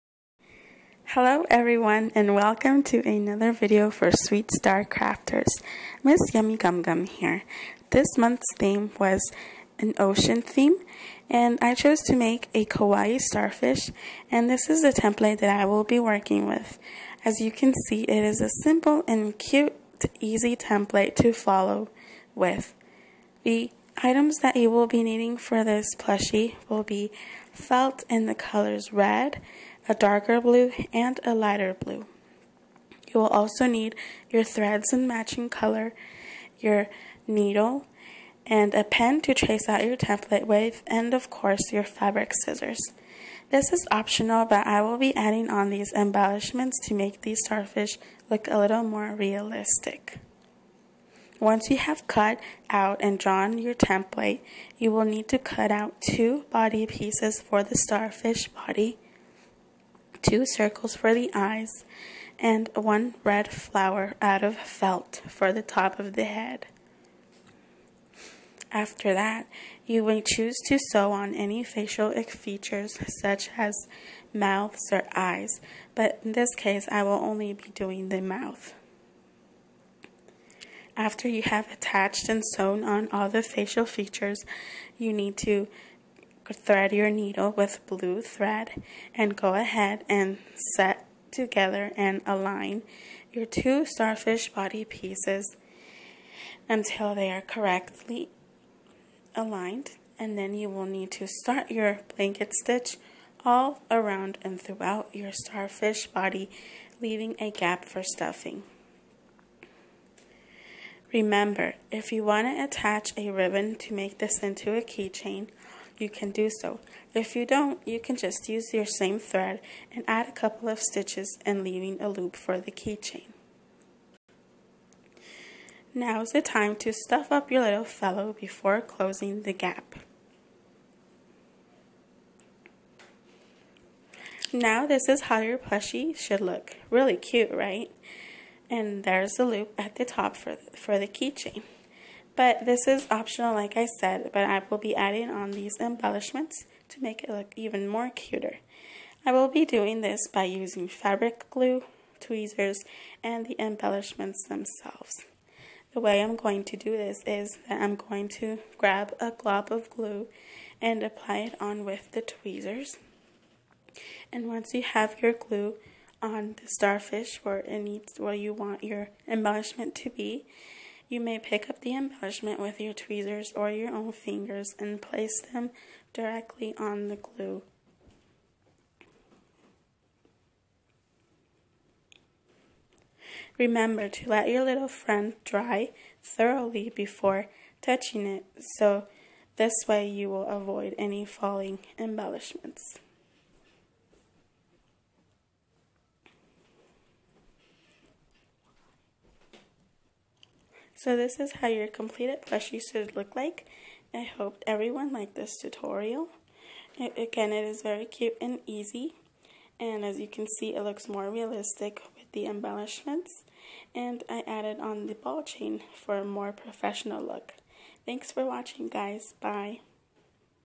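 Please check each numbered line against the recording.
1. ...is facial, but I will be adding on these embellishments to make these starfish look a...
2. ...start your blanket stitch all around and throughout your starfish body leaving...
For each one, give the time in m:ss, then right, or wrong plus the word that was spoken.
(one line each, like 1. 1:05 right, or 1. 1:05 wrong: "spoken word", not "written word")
1. 0:43 wrong: "optional", not "facial"
2. 1:41 right.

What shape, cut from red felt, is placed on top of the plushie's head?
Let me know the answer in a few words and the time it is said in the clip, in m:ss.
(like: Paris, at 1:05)
flower, at 1:03.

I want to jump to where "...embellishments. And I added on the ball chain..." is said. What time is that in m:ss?
3:32.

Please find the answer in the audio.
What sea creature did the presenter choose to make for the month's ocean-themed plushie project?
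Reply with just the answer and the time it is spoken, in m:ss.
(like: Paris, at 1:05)
kawaii starfish, at 0:12.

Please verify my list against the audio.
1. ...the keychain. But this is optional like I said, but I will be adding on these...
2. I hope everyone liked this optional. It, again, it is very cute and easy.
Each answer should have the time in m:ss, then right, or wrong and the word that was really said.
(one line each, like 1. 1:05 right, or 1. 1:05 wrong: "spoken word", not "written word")
1. 2:20 right
2. 3:24 wrong: "tutorial", not "optional".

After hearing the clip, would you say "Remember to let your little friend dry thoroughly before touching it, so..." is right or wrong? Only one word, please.
right.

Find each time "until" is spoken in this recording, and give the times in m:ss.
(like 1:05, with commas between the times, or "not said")
1:36.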